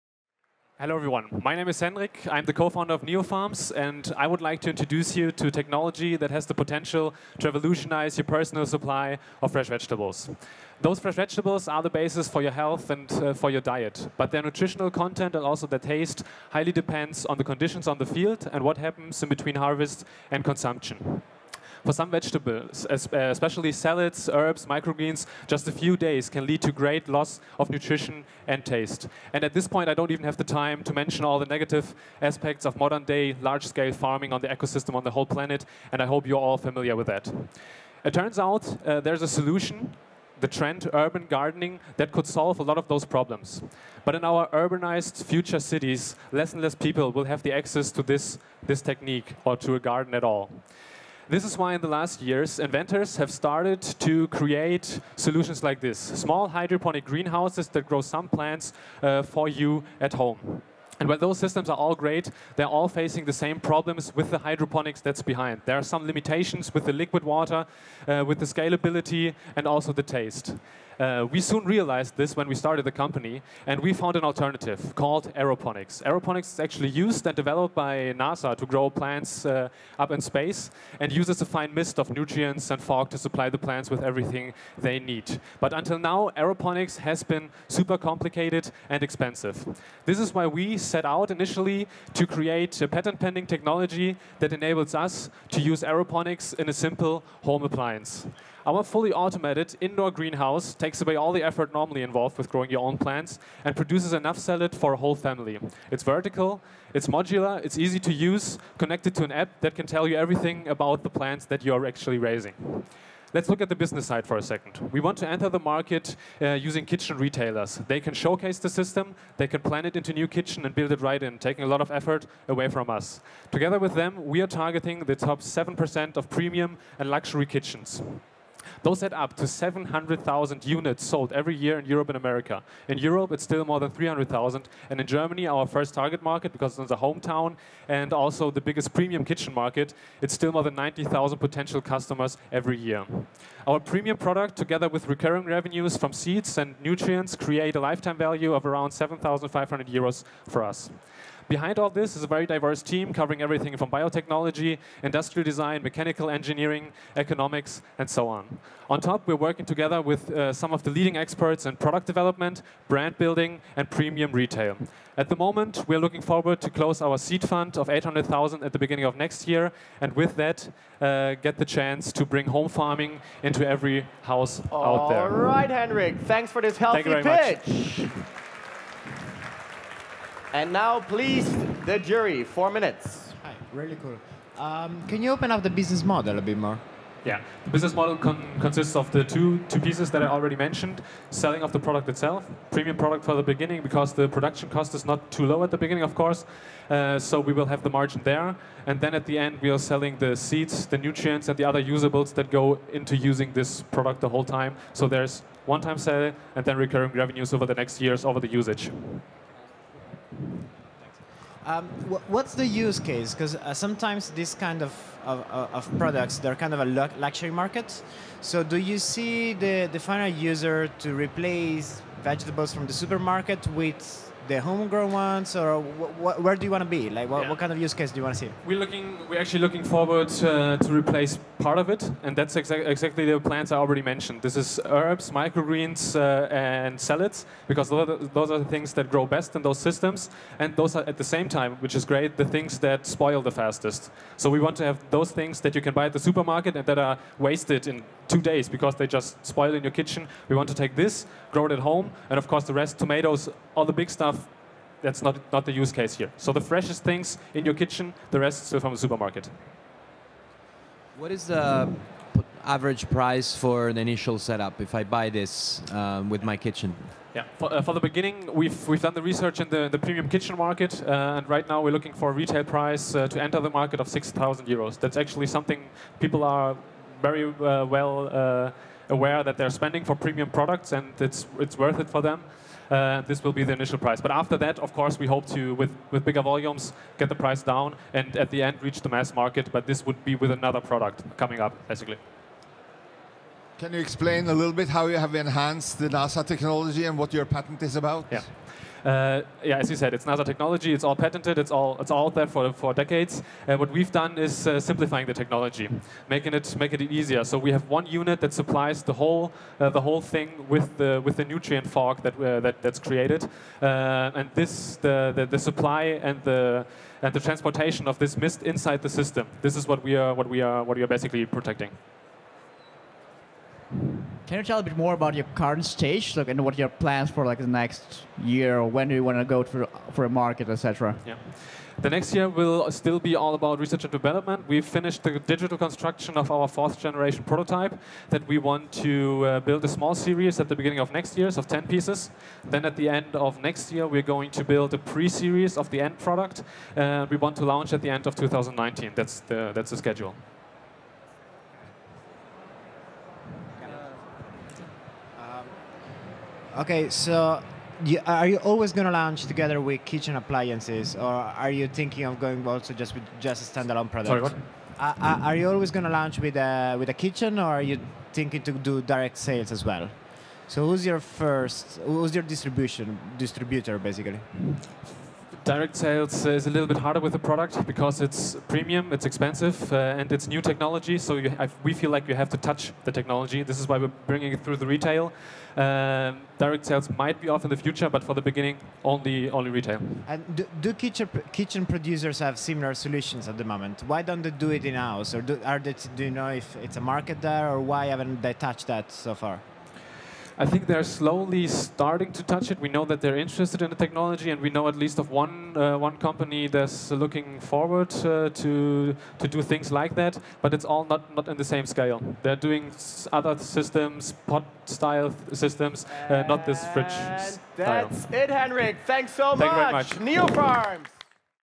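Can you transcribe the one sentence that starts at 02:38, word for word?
On top, we're working together with uh, some of the leading experts in product development, brand building, and premium retail.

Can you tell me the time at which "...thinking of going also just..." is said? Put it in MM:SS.
06:01.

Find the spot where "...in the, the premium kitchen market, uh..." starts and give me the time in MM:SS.
04:29.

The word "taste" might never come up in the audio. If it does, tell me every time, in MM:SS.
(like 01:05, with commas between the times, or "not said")
00:15, 00:28, 01:10.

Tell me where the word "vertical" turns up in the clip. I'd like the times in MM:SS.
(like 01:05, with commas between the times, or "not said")
01:46.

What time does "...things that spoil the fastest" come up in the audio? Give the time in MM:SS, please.
04:02.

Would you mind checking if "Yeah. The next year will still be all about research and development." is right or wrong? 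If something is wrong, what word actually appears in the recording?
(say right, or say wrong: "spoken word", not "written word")
right.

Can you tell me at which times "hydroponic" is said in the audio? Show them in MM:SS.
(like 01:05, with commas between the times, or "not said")
00:56, 01:04.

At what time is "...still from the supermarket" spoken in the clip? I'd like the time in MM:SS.
04:18.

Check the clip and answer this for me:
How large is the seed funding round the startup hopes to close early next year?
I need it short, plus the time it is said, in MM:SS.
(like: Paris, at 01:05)
800,000, at 02:47.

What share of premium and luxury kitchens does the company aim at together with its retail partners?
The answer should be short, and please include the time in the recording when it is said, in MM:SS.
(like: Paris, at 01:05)
7%, at 02:05.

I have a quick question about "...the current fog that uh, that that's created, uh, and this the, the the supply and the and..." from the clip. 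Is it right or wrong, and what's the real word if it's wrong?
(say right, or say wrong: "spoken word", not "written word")
wrong: "nutrient", not "current".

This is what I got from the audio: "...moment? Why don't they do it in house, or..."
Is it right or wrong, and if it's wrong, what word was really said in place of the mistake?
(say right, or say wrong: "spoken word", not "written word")
right.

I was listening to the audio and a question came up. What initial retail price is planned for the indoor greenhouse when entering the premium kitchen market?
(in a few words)
6,000 euros.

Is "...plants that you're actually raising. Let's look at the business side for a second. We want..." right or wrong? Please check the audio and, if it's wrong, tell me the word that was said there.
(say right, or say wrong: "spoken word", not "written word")
right.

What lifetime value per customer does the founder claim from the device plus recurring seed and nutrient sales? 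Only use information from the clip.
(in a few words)
7,500 euros.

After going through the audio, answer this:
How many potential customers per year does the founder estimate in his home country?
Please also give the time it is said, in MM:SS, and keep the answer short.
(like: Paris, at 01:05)
more than 90,000, at 02:20.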